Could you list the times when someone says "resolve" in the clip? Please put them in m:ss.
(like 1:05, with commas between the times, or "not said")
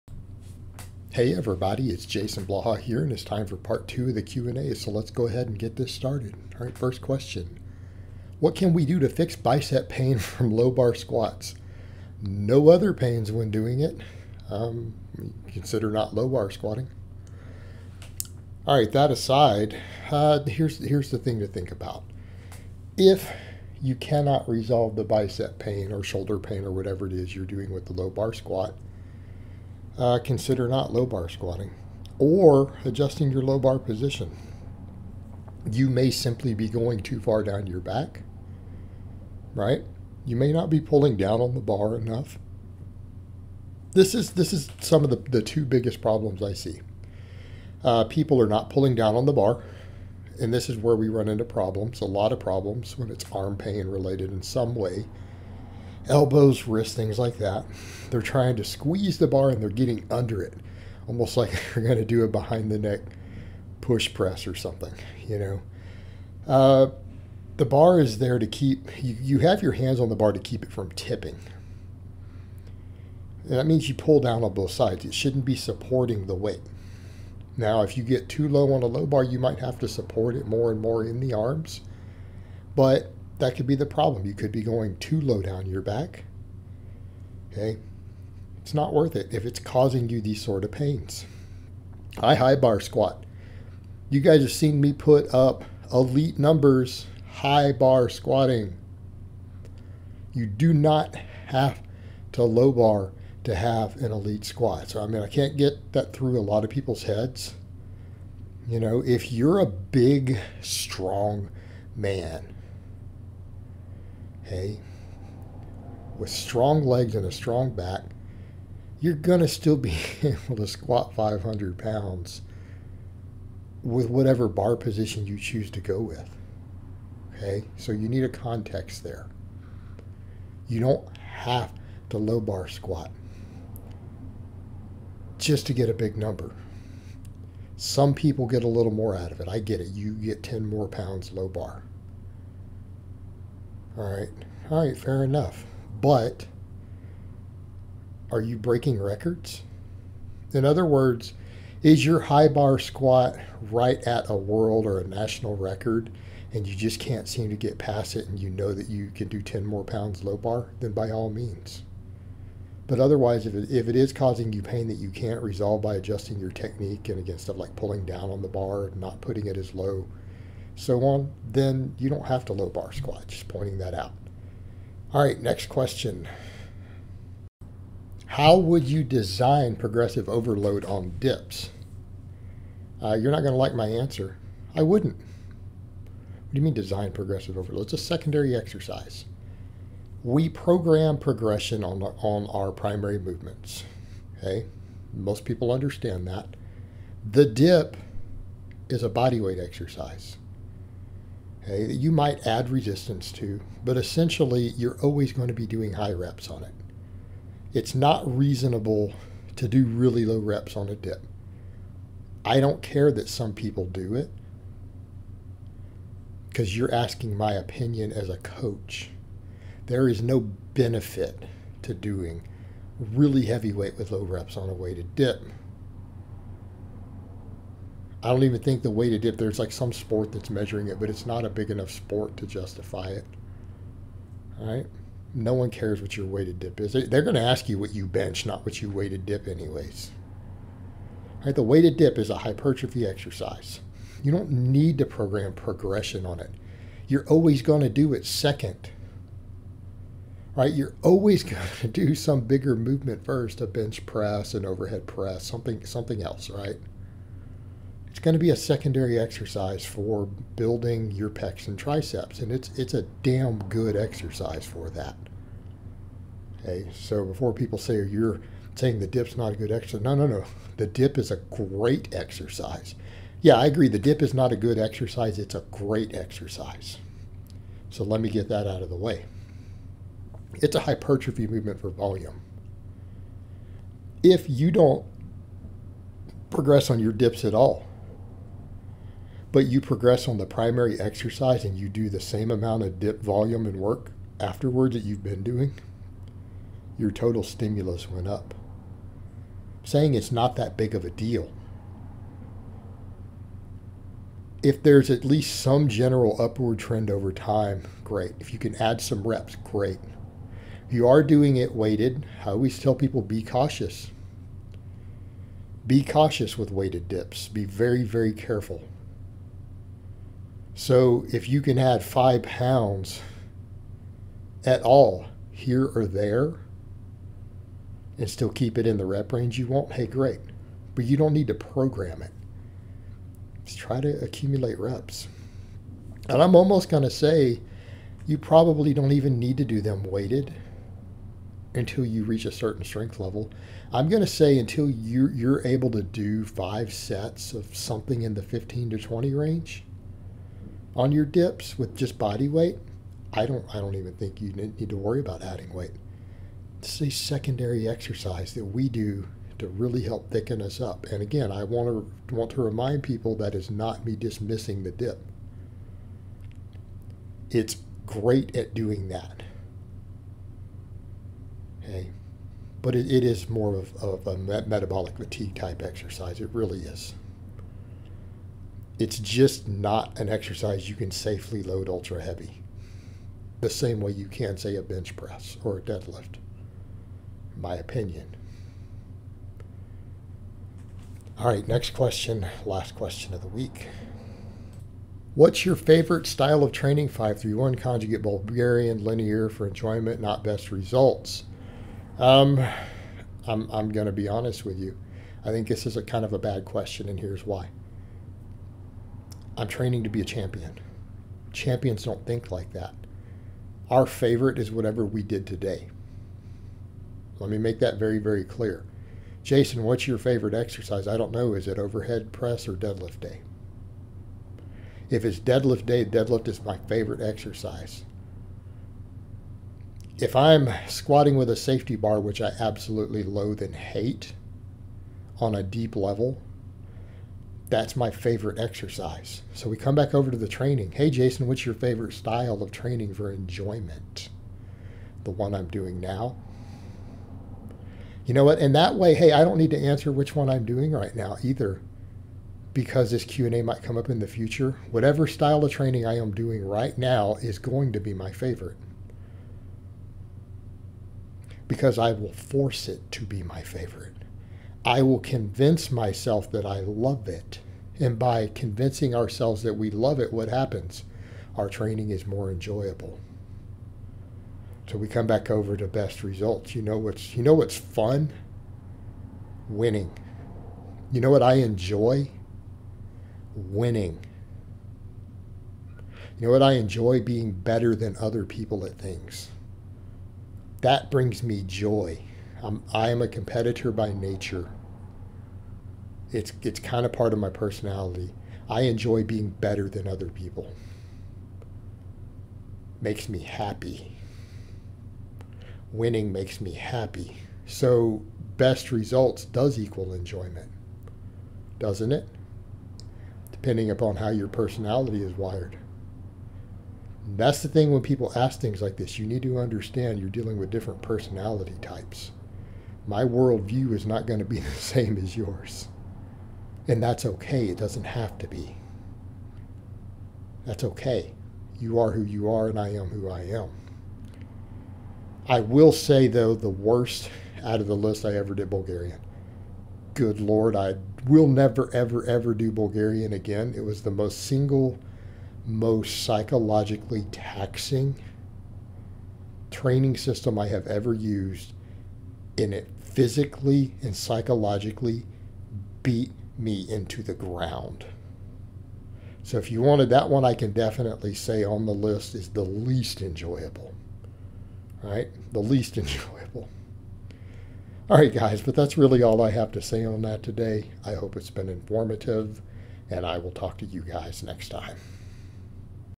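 0:24, 2:45.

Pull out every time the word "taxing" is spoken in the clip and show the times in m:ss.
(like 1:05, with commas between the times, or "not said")
9:07.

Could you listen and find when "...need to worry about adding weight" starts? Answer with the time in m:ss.
5:54.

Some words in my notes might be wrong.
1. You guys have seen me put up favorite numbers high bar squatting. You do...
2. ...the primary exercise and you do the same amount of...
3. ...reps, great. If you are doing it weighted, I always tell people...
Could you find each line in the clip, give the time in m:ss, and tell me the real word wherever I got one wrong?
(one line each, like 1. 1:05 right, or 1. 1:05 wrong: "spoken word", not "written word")
1. 1:34 wrong: "elite", not "favorite"
2. 4:50 right
3. 5:09 right.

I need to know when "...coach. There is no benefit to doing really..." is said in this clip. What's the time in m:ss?
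3:38.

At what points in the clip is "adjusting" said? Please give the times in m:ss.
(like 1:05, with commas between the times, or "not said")
0:32, 2:45.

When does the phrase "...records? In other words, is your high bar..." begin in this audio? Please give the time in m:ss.
2:29.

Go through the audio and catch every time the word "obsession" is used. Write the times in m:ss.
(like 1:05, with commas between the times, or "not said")
not said.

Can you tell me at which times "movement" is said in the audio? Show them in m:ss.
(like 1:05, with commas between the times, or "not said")
3:13, 4:12, 4:41.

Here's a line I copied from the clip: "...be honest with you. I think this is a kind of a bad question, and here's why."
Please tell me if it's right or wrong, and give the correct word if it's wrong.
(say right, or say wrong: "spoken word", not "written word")
right.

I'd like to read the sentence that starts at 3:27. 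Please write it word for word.
It's not reasonable to do really low reps on a dip.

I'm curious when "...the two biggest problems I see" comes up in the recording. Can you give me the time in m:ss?
0:45.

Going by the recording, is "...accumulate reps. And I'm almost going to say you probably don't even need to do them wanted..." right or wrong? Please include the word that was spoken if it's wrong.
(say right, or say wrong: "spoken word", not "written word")
wrong: "weighted", not "wanted".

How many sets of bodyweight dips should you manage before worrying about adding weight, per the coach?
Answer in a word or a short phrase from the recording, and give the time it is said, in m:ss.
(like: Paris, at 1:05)
5, at 5:46.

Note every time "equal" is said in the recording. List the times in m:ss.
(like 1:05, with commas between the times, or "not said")
8:29.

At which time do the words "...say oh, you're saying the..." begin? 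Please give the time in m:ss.
4:27.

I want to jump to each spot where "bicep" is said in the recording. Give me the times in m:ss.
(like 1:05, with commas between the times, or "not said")
0:09, 0:25.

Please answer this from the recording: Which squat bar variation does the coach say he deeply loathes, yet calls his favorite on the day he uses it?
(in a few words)
safety bar.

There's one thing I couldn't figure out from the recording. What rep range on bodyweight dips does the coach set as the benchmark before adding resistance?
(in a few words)
15 to 20.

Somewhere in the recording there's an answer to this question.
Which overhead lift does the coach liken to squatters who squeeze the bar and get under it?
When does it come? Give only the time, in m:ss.
1:02.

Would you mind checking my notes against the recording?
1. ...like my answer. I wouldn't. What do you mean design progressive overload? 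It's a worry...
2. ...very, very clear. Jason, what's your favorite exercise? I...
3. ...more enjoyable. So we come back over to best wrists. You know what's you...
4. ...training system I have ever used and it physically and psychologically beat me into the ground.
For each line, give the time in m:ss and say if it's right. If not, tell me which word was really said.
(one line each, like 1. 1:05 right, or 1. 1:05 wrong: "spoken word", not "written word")
1. 3:03 wrong: "secondary", not "worry"
2. 6:57 right
3. 7:52 wrong: "results", not "wrists"
4. 9:09 right.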